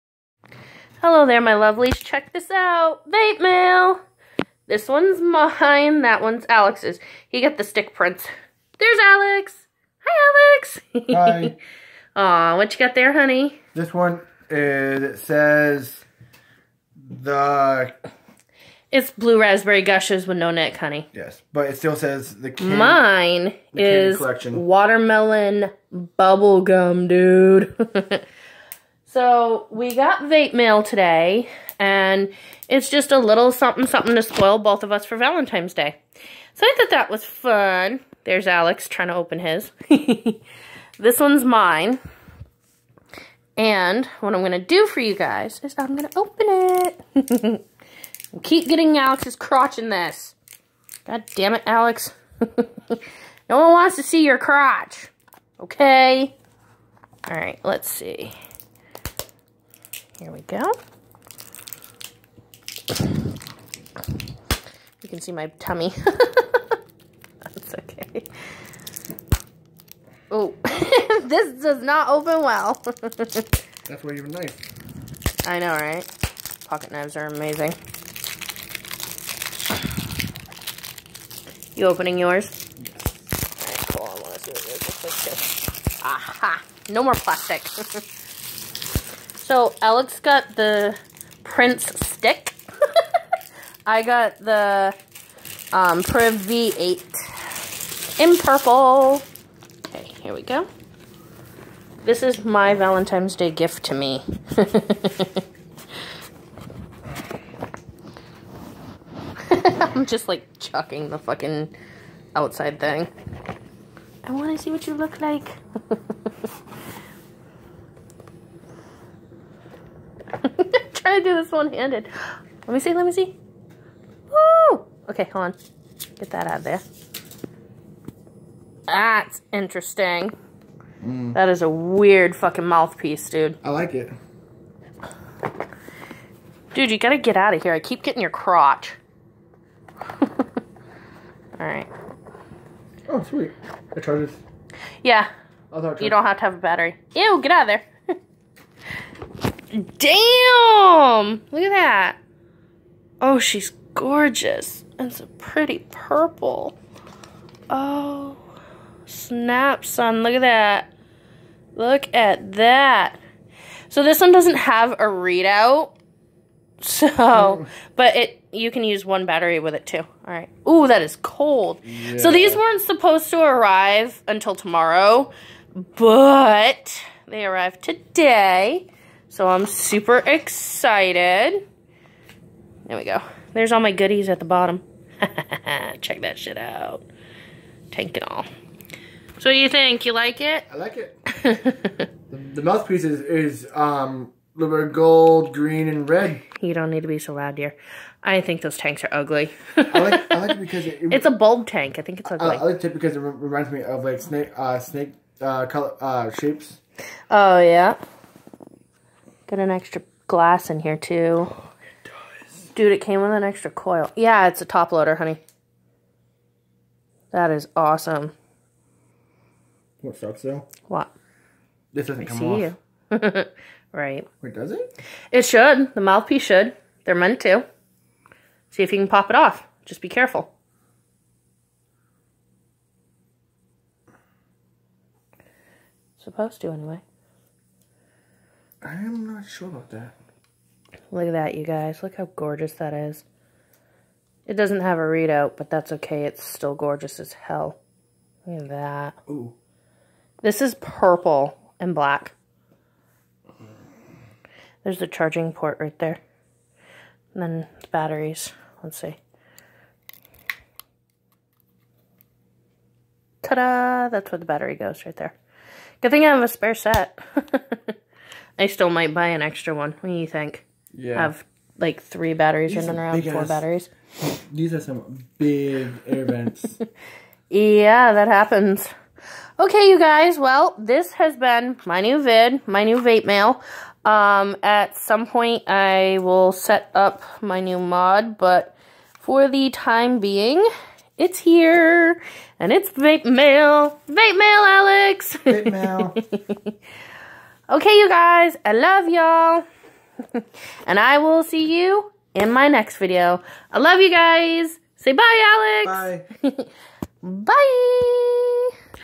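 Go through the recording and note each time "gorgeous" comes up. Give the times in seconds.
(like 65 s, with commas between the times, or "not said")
153 s, 242 s, 246 s.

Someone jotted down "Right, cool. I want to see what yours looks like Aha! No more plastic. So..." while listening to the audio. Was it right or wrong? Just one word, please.
right.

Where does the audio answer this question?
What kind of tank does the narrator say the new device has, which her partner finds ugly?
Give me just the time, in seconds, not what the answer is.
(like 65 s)
201 s.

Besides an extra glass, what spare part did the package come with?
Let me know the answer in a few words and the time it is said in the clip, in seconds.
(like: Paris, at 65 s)
An extra coil, at 213 s.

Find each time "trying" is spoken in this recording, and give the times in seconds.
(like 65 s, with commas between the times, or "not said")
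38 s, 120 s.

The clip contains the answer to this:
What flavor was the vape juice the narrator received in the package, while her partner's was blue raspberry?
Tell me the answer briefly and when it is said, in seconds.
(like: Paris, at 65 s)
Watermelon bubblegum, at 24 s.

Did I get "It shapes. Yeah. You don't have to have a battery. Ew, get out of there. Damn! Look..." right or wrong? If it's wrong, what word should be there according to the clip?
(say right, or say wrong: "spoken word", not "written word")
wrong: "charges", not "shapes".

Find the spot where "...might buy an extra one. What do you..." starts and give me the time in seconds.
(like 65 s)
268 s.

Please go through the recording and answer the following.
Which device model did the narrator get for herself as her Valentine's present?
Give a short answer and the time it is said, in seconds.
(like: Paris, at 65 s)
Priv V8, at 96 s.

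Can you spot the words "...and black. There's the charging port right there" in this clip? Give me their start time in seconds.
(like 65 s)
251 s.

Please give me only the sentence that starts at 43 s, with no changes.
And what I'm going to do for you guys is I'm going to open it.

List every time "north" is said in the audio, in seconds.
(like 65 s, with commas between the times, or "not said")
not said.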